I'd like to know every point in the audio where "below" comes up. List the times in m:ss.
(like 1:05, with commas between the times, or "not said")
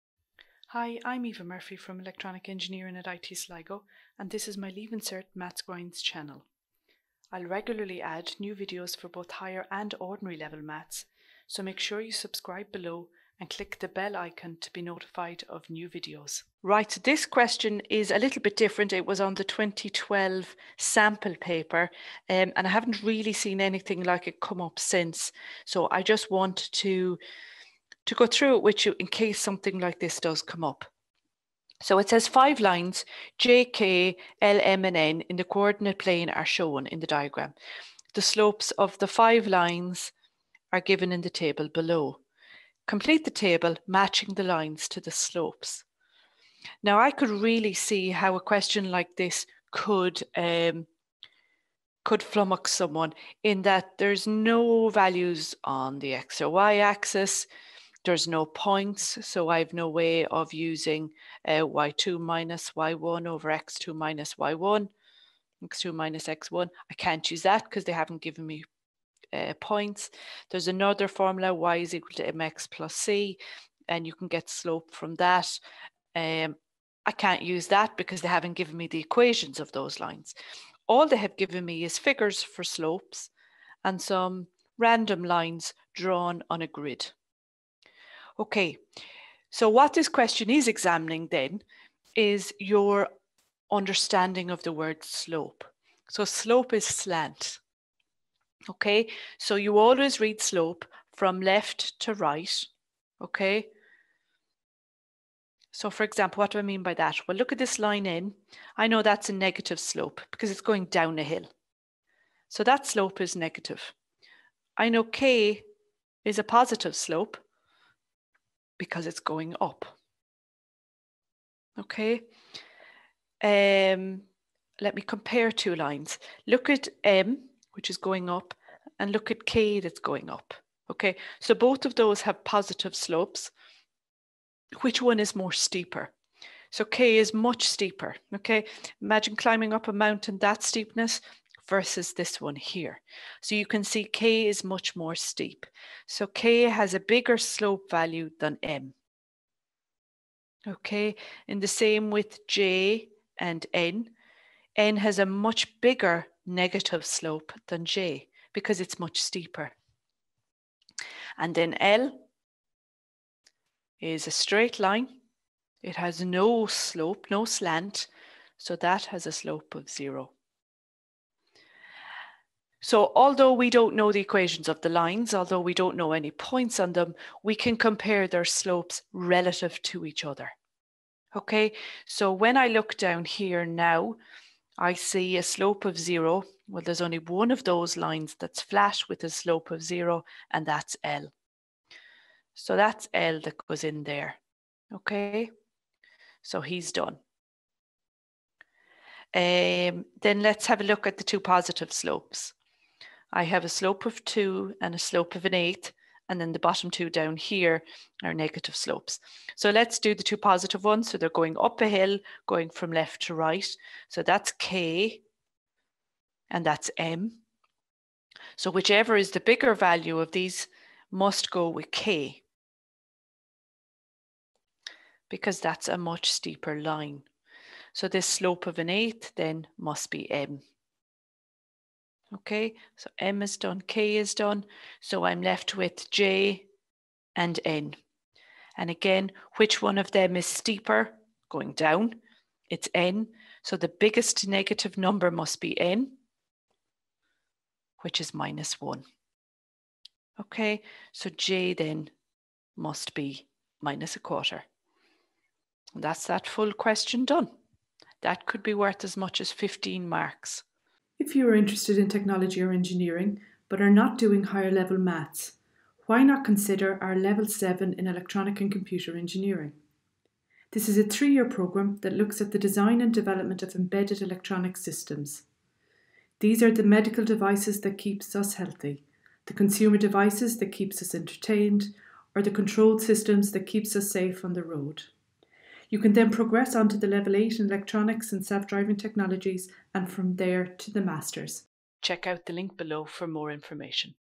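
0:12, 0:41, 4:52.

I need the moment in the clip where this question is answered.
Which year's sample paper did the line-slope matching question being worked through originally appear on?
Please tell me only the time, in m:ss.
0:19.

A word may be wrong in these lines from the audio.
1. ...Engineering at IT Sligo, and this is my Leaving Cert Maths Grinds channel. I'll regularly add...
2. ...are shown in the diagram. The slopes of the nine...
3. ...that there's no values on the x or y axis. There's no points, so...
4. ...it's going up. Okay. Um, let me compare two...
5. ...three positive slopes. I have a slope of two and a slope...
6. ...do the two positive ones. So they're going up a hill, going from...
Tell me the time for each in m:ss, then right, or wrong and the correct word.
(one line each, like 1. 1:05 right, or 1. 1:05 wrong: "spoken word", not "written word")
1. 0:02 right
2. 0:36 wrong: "five", not "nine"
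3. 0:53 right
4. 1:59 right
5. 3:21 wrong: "two", not "three"
6. 3:29 right.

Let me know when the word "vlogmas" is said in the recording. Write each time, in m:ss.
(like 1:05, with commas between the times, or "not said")
not said.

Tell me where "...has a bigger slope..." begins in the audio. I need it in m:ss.
2:26.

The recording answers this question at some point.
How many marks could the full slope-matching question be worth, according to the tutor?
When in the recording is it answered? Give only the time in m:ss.
4:19.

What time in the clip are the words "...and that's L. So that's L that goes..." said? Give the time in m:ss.
3:10.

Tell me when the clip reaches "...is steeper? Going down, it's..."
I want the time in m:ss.
4:00.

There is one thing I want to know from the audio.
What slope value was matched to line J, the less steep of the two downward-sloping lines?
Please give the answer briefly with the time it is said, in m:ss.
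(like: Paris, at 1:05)
-1/4, at 4:13.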